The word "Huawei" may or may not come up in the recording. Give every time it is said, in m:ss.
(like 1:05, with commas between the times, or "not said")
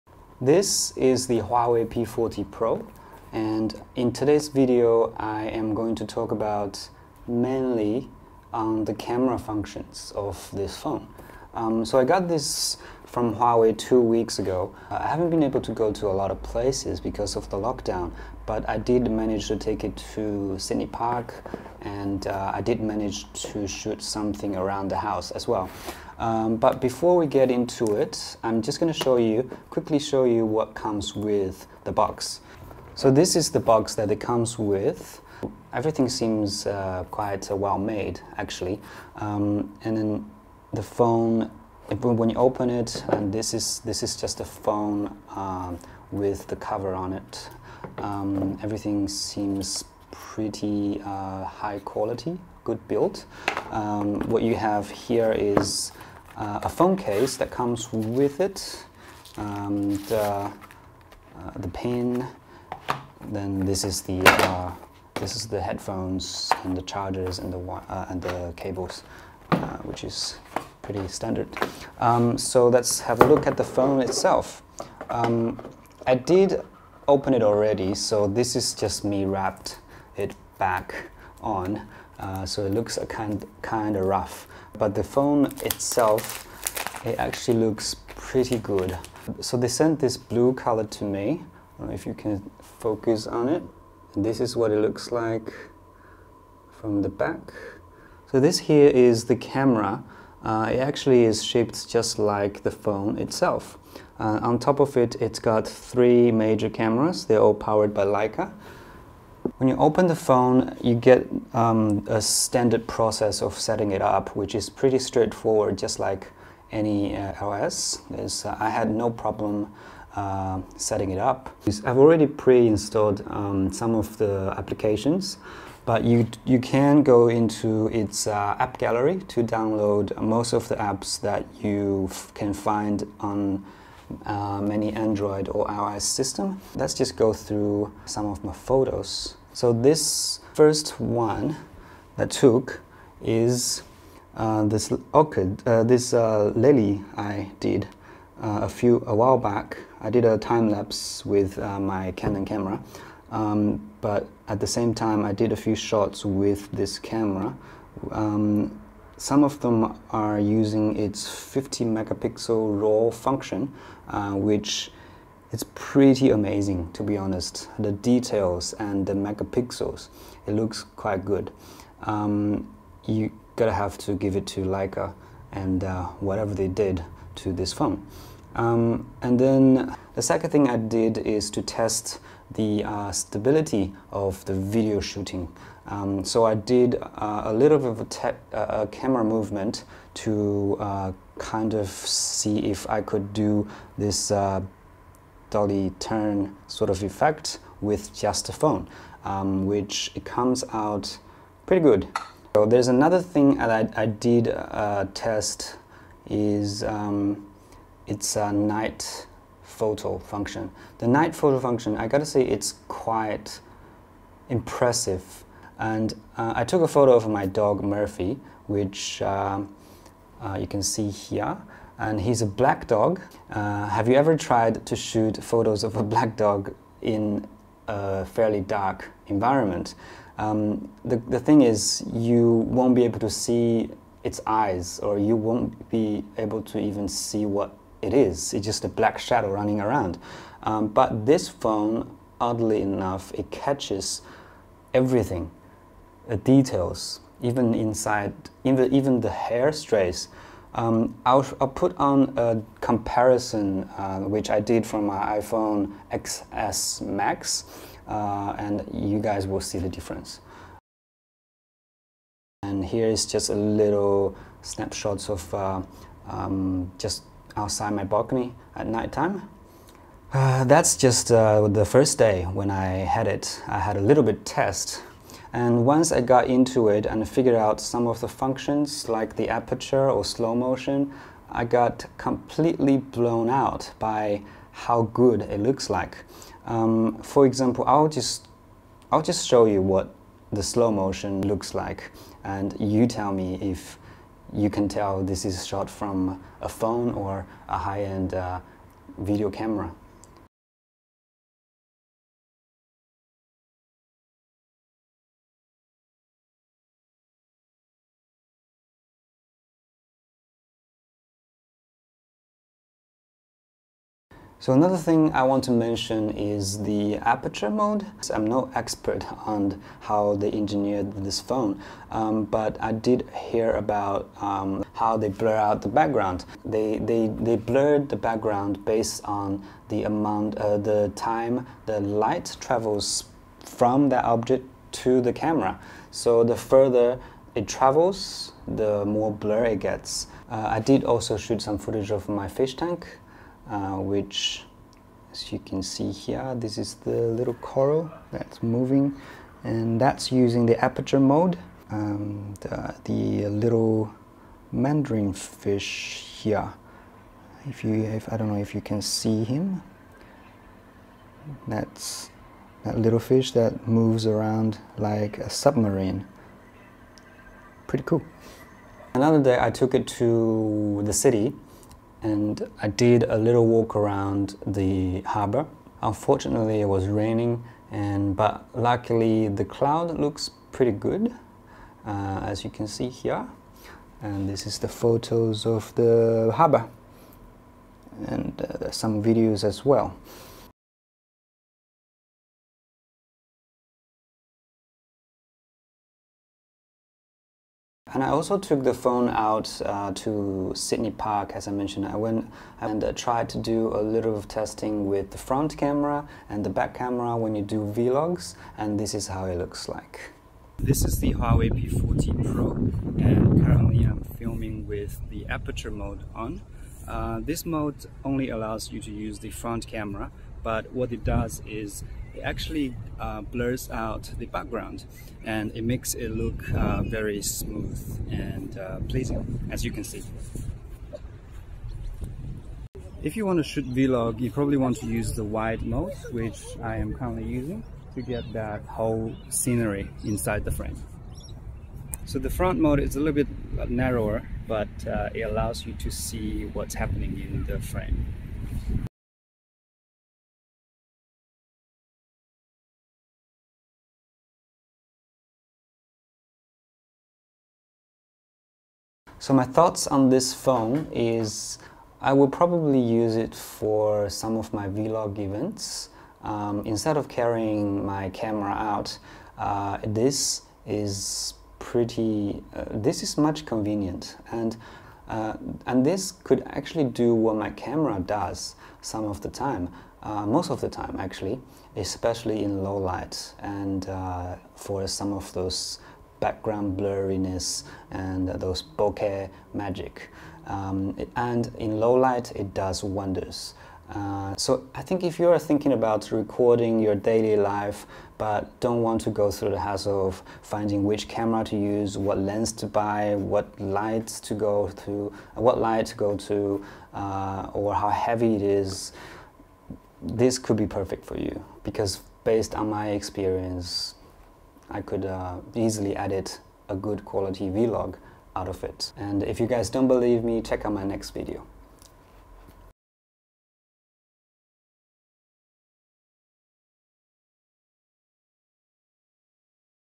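0:01, 0:13, 6:51.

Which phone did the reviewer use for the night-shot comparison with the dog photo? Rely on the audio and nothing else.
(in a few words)
iPhone XS Max.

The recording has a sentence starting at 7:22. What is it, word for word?
So the front mode is a little bit uh, narrower, but uh, it allows you to see what's happening in the frame.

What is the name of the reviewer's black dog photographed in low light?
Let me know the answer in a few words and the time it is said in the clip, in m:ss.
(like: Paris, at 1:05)
Murphy, at 3:37.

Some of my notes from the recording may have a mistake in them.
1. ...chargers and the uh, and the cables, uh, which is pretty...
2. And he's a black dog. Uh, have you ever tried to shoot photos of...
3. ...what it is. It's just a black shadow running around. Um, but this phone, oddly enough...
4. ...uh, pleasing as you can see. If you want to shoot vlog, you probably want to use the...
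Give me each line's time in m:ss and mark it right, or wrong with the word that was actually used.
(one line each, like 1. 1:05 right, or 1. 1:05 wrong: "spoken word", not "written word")
1. 1:06 right
2. 3:41 right
3. 3:57 right
4. 7:08 right.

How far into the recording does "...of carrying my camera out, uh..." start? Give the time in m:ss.
7:47.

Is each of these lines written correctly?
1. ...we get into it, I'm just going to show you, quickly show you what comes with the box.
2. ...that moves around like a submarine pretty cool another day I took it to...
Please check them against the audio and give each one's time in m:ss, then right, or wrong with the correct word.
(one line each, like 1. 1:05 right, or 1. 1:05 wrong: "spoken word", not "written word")
1. 0:27 right
2. 6:03 right.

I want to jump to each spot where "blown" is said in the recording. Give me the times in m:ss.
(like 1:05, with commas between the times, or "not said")
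4:42.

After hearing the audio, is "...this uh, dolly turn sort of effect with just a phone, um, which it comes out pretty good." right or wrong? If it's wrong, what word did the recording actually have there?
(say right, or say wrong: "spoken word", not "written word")
right.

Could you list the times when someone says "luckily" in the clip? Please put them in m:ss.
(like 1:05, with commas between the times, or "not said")
6:18.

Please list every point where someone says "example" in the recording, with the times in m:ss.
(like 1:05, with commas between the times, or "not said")
4:47.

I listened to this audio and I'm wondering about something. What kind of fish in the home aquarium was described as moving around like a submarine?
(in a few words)
Mandarin fish.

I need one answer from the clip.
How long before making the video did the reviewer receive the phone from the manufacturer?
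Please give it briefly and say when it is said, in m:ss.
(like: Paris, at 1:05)
2 weeks, at 0:13.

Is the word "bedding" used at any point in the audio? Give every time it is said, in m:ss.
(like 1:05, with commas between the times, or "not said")
not said.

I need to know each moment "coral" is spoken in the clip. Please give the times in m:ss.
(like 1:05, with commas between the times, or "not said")
5:47.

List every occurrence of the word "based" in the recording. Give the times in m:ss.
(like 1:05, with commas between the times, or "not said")
5:28, 8:32.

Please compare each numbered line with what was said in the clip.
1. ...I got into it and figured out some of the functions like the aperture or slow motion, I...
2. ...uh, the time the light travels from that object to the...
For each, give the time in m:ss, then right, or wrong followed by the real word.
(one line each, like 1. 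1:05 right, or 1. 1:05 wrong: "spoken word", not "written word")
1. 4:36 right
2. 5:30 right.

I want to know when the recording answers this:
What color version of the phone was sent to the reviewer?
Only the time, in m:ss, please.
1:30.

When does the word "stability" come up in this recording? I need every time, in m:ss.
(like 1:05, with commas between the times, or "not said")
3:03.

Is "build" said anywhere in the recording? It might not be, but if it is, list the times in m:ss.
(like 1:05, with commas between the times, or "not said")
0:52.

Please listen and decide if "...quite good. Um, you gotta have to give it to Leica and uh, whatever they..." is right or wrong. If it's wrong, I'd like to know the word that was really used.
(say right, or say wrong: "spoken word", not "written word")
right.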